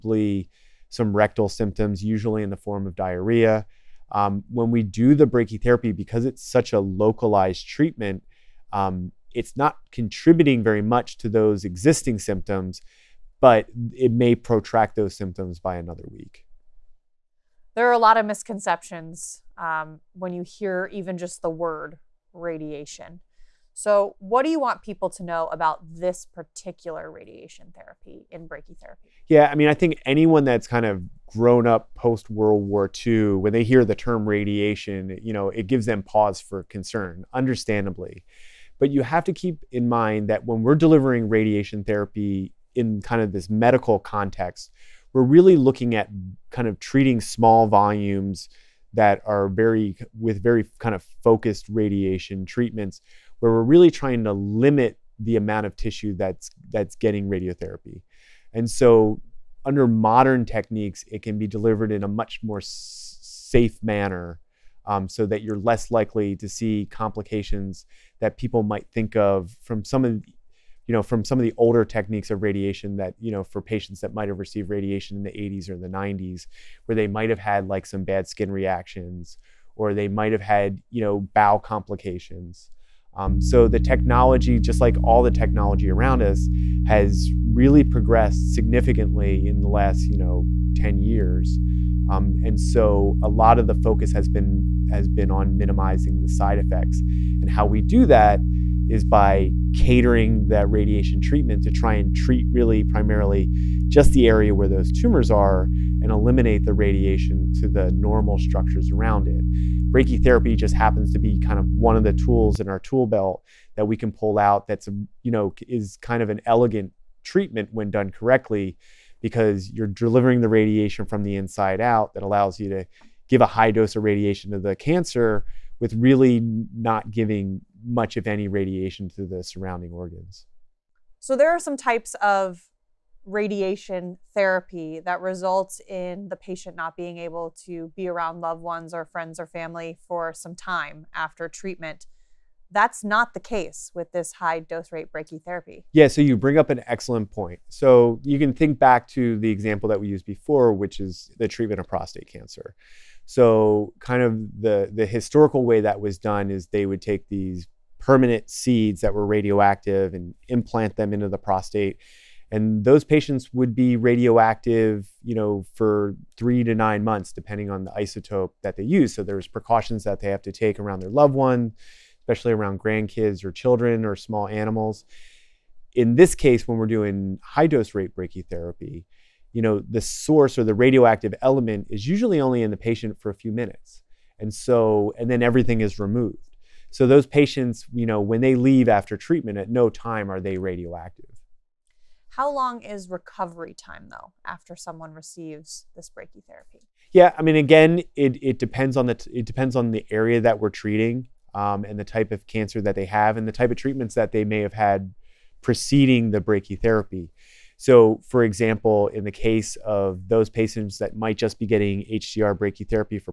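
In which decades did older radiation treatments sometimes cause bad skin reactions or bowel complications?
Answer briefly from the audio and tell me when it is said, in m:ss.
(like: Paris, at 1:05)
80s or 90s, at 1:15.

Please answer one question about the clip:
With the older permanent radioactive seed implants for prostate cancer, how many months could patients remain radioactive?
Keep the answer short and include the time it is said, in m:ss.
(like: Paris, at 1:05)
3 to 9 months, at 2:46.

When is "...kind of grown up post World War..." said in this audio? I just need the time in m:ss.
0:30.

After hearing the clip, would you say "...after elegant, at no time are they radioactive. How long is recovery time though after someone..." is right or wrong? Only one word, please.
wrong.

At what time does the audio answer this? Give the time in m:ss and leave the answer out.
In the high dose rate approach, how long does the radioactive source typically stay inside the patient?
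3:03.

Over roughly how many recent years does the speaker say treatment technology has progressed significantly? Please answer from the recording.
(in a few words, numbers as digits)
10 years.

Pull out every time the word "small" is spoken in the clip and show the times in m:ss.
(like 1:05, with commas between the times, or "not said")
0:47, 2:54.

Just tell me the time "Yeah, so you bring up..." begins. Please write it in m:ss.
2:25.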